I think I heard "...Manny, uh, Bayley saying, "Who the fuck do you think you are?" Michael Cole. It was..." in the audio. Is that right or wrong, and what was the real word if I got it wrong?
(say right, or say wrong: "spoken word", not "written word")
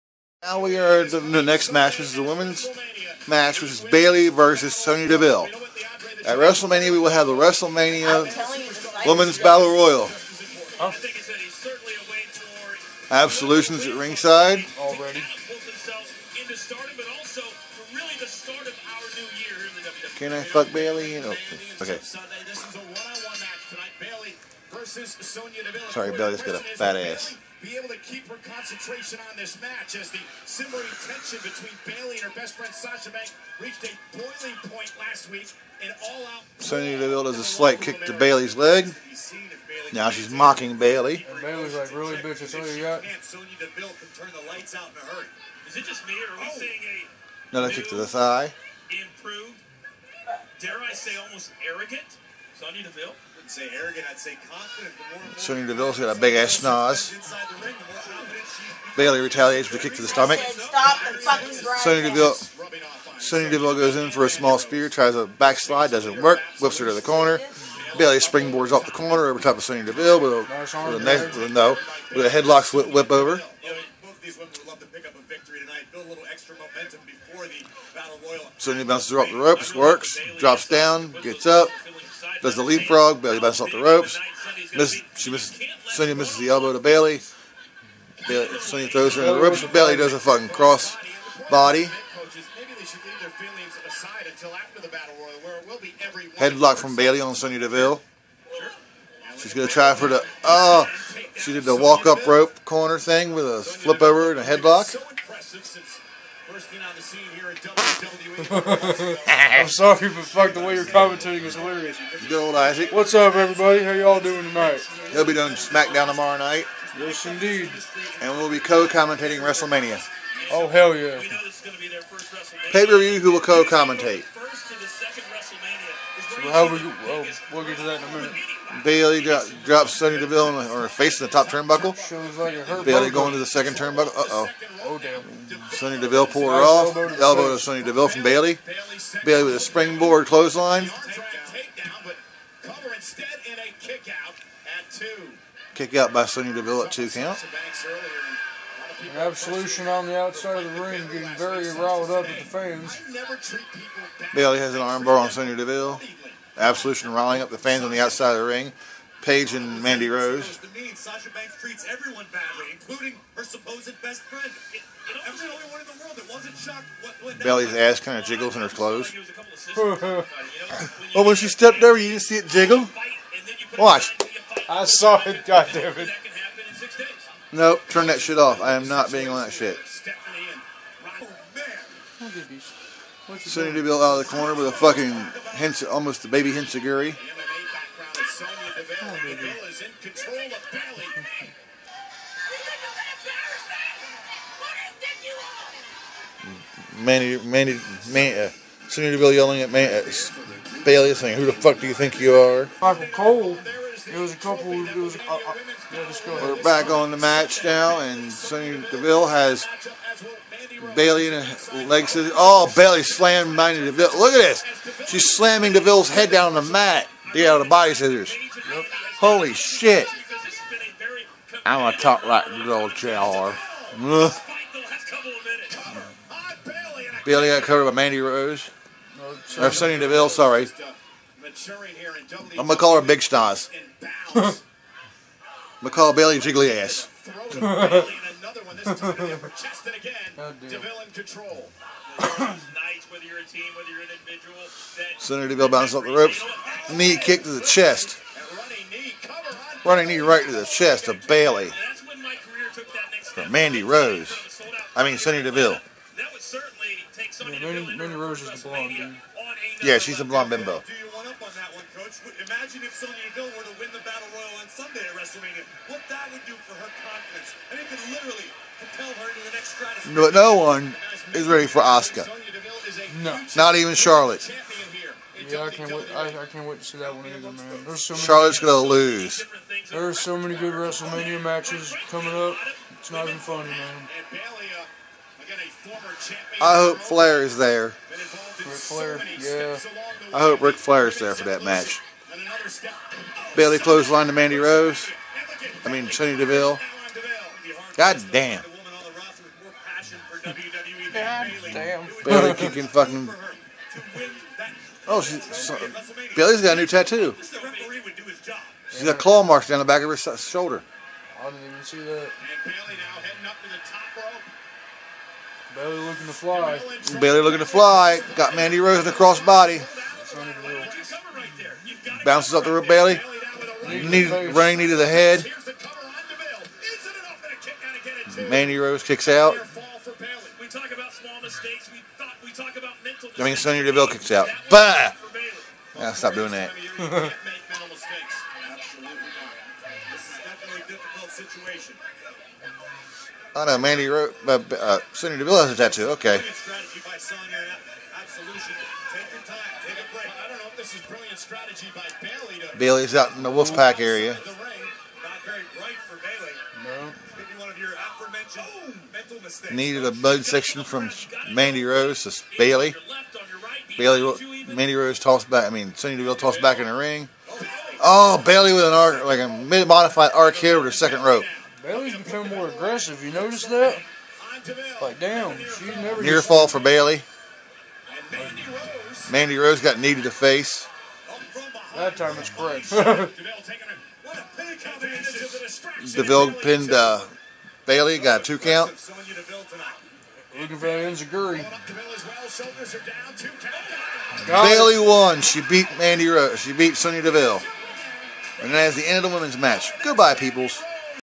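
right.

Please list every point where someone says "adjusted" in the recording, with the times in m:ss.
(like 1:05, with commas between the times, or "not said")
not said.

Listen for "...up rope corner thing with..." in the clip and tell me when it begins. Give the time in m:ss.
1:42.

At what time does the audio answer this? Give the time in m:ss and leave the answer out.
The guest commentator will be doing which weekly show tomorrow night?
1:55.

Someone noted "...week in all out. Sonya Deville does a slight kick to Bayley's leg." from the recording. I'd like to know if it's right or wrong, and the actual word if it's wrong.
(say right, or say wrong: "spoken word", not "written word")
right.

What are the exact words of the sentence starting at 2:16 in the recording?
Elbow to Sonny Deville from Bayley.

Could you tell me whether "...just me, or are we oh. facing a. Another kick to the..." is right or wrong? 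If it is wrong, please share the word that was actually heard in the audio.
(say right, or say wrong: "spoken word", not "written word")
wrong: "seeing", not "facing".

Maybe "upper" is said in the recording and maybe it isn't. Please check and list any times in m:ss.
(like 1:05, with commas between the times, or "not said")
3:59.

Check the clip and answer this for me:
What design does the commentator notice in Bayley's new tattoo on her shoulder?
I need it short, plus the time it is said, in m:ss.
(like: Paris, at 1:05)
claw marks, at 5:09.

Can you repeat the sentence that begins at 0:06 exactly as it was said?
At WrestleMania, we will have the WrestleMania Women's Battle Royal.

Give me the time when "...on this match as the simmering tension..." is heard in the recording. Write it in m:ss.
0:29.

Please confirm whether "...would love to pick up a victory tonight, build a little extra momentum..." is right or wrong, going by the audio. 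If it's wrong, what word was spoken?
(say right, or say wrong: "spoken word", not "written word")
right.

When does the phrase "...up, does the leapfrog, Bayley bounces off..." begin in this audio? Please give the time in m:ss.
1:21.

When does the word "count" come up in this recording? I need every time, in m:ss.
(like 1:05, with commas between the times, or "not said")
2:27, 6:28.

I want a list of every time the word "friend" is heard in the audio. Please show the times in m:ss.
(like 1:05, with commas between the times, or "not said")
0:32, 2:44.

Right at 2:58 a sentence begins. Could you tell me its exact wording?
I am not being on that shit.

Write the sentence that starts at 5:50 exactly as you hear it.
I don't know if this is brilliant strategy by Bayley's out in the Wolfpack area.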